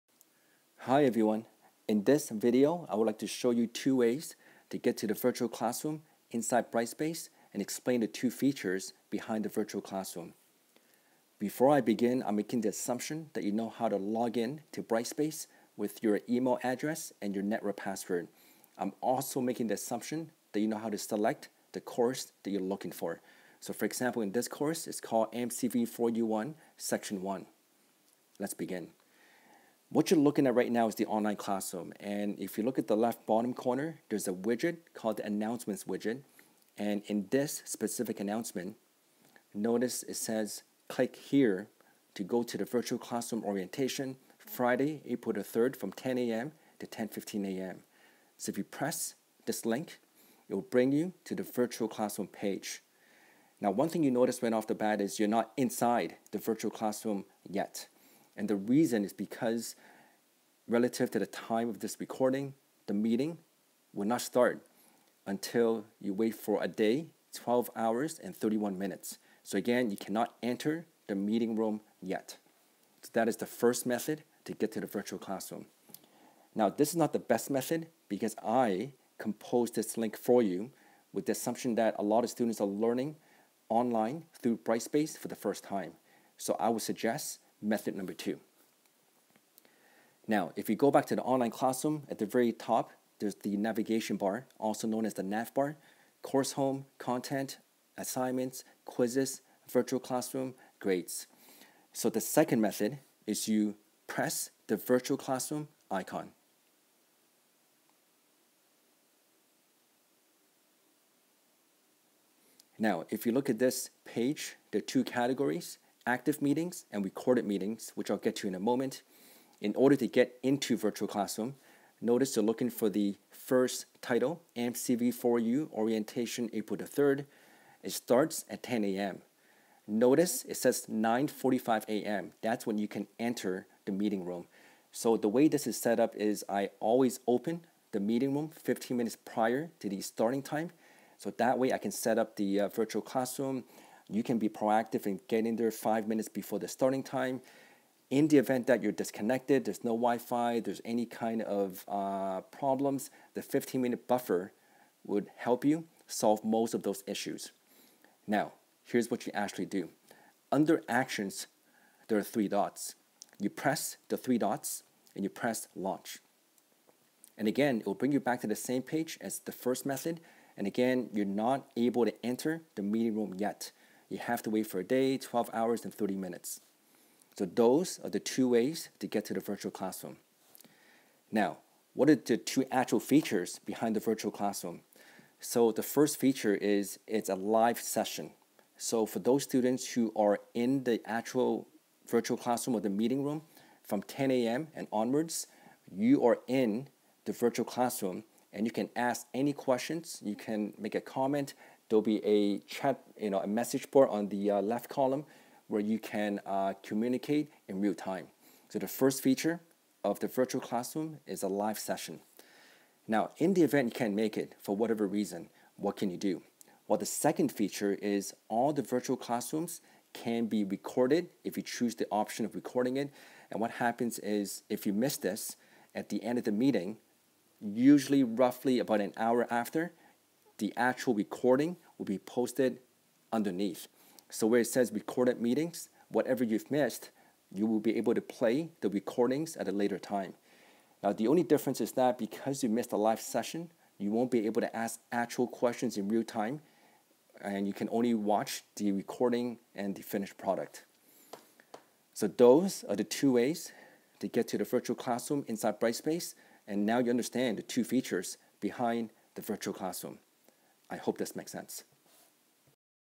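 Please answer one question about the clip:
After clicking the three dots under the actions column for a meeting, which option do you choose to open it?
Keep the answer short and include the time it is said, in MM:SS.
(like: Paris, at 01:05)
launch, at 02:45.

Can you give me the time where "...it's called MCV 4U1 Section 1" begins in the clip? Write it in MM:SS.
00:24.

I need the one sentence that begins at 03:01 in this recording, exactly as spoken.
Now, what are the two actual features behind the virtual classroom?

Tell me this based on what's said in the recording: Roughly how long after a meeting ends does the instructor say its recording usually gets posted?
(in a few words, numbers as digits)
about an hour.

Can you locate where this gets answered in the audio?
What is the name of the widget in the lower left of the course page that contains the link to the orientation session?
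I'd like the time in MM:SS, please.
00:35.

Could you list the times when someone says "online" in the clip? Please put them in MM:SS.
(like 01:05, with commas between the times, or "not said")
00:31, 01:23, 01:31.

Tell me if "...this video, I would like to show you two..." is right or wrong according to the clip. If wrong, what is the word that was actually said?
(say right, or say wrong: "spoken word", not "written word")
right.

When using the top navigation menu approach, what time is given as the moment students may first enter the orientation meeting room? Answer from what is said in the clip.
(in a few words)
9:45 a.m.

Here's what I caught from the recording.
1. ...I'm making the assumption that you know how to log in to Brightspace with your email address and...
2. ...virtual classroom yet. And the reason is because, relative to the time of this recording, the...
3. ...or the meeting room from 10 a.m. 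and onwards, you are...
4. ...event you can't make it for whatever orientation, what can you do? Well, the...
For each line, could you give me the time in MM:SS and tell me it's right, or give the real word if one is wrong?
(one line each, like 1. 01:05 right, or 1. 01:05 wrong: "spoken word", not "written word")
1. 00:12 right
2. 00:56 right
3. 03:12 right
4. 03:33 wrong: "reason", not "orientation".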